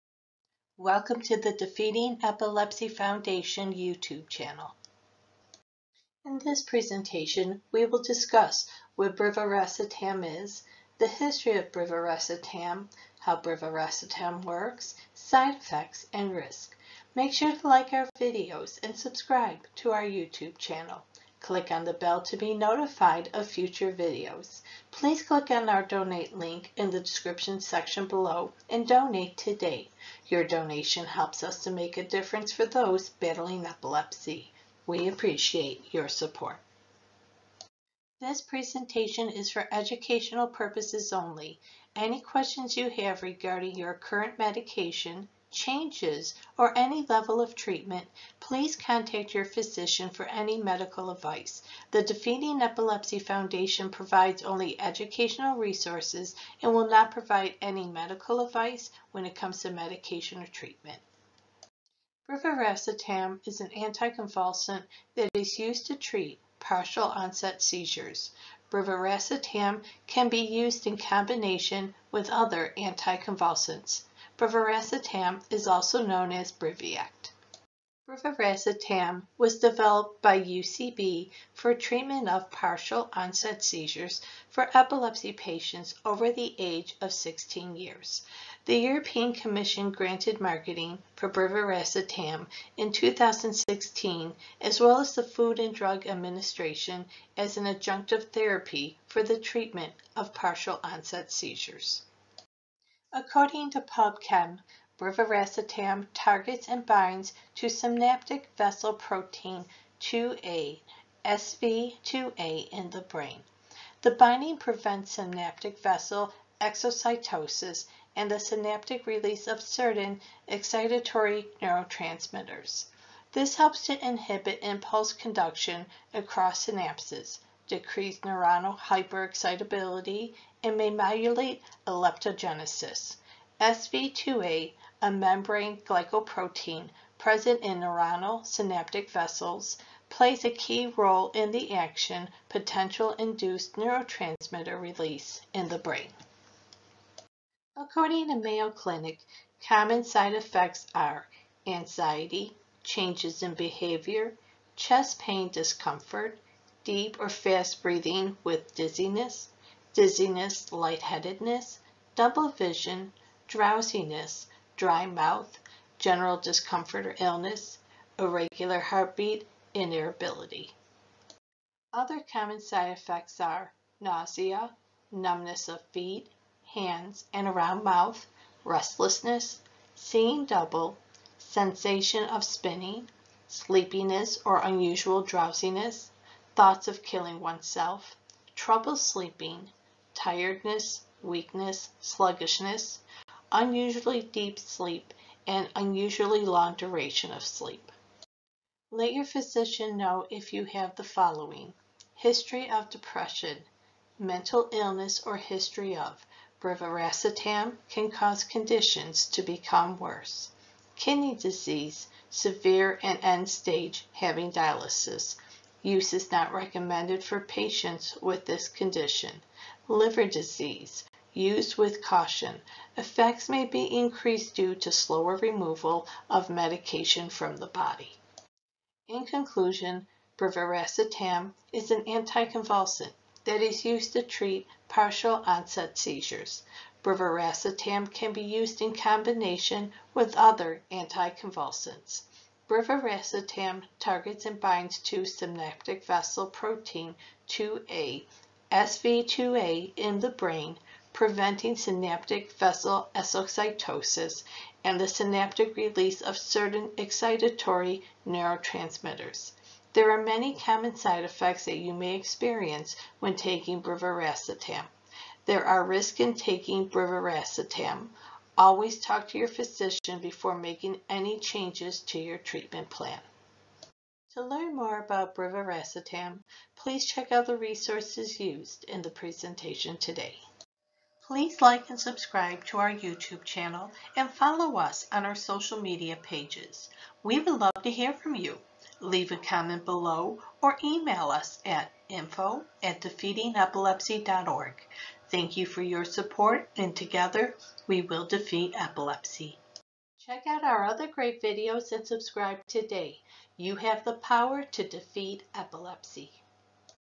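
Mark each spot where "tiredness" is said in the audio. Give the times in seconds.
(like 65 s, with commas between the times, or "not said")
190 s.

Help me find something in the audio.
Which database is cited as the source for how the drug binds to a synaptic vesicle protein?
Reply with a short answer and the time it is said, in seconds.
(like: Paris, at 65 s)
PubChem, at 103 s.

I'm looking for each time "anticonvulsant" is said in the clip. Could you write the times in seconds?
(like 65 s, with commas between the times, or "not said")
63 s, 72 s, 232 s, 240 s.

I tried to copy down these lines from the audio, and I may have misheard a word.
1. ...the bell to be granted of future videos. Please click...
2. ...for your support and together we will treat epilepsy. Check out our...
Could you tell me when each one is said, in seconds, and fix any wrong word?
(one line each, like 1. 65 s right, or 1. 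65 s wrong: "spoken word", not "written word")
1. 21 s wrong: "notified", not "granted"
2. 295 s wrong: "defeat", not "treat".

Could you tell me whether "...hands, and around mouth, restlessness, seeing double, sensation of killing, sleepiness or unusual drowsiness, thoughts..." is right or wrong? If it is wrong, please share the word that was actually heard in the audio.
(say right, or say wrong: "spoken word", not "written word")
wrong: "spinning", not "killing".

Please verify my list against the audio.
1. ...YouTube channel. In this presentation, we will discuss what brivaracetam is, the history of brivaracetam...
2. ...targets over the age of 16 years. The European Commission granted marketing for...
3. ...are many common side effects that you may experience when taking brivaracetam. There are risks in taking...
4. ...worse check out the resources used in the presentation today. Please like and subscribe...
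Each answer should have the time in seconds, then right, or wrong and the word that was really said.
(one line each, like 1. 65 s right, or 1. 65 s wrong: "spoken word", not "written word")
1. 3 s right
2. 85 s wrong: "patients", not "targets"
3. 260 s right
4. 276 s wrong: "please", not "worse".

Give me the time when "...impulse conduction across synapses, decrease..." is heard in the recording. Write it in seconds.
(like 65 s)
124 s.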